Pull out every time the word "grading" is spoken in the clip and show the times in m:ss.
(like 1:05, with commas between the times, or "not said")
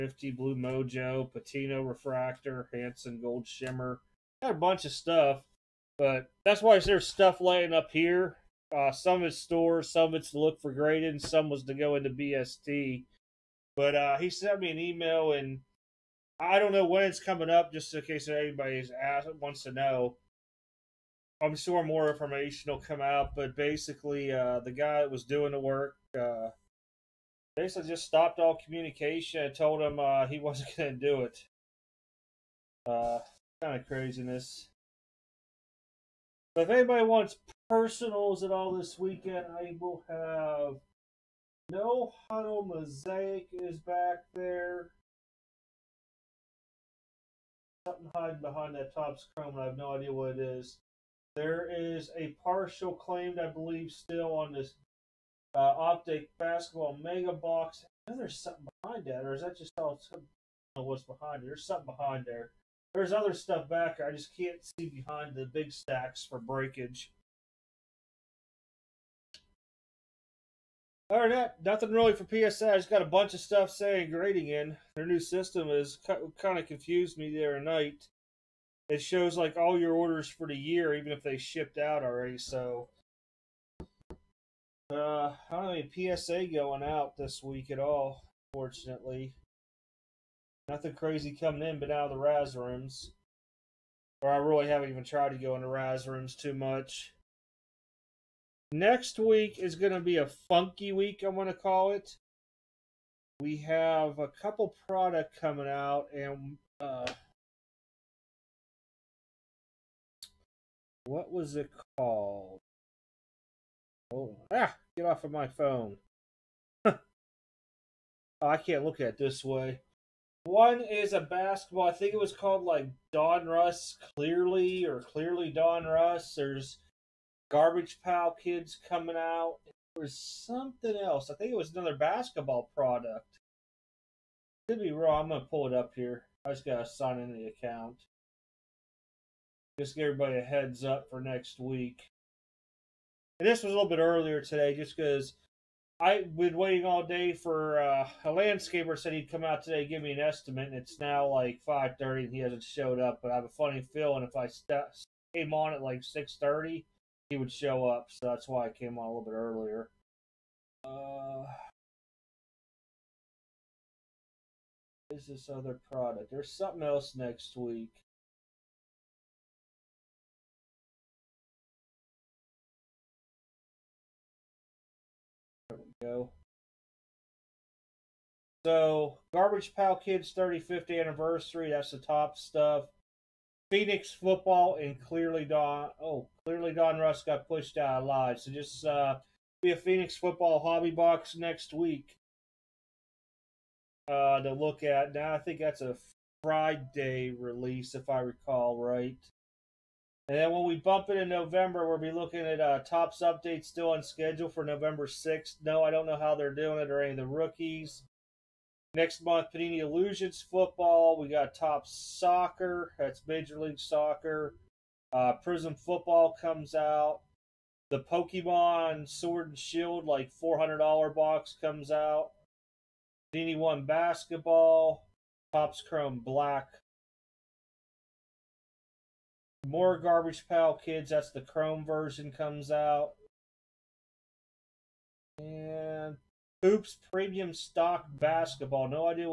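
0:10, 1:14.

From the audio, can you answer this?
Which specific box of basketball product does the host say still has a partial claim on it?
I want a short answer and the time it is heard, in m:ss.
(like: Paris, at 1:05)
Optic Basketball Mega Box, at 0:55.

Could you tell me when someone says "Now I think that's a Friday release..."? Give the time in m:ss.
3:15.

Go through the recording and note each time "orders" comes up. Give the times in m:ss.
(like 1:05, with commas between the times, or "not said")
1:19.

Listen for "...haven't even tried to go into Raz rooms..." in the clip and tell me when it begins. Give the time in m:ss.
1:34.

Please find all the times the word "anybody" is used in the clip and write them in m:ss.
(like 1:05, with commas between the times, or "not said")
0:18, 0:36.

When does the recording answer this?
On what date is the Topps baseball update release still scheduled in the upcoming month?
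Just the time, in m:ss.
3:24.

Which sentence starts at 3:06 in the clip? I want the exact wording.
Oh, clearly Donruss got pushed out alive.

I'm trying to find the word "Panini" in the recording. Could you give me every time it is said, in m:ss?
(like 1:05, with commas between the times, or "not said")
3:29, 3:43.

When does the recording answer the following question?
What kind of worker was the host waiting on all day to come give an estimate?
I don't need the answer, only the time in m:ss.
2:28.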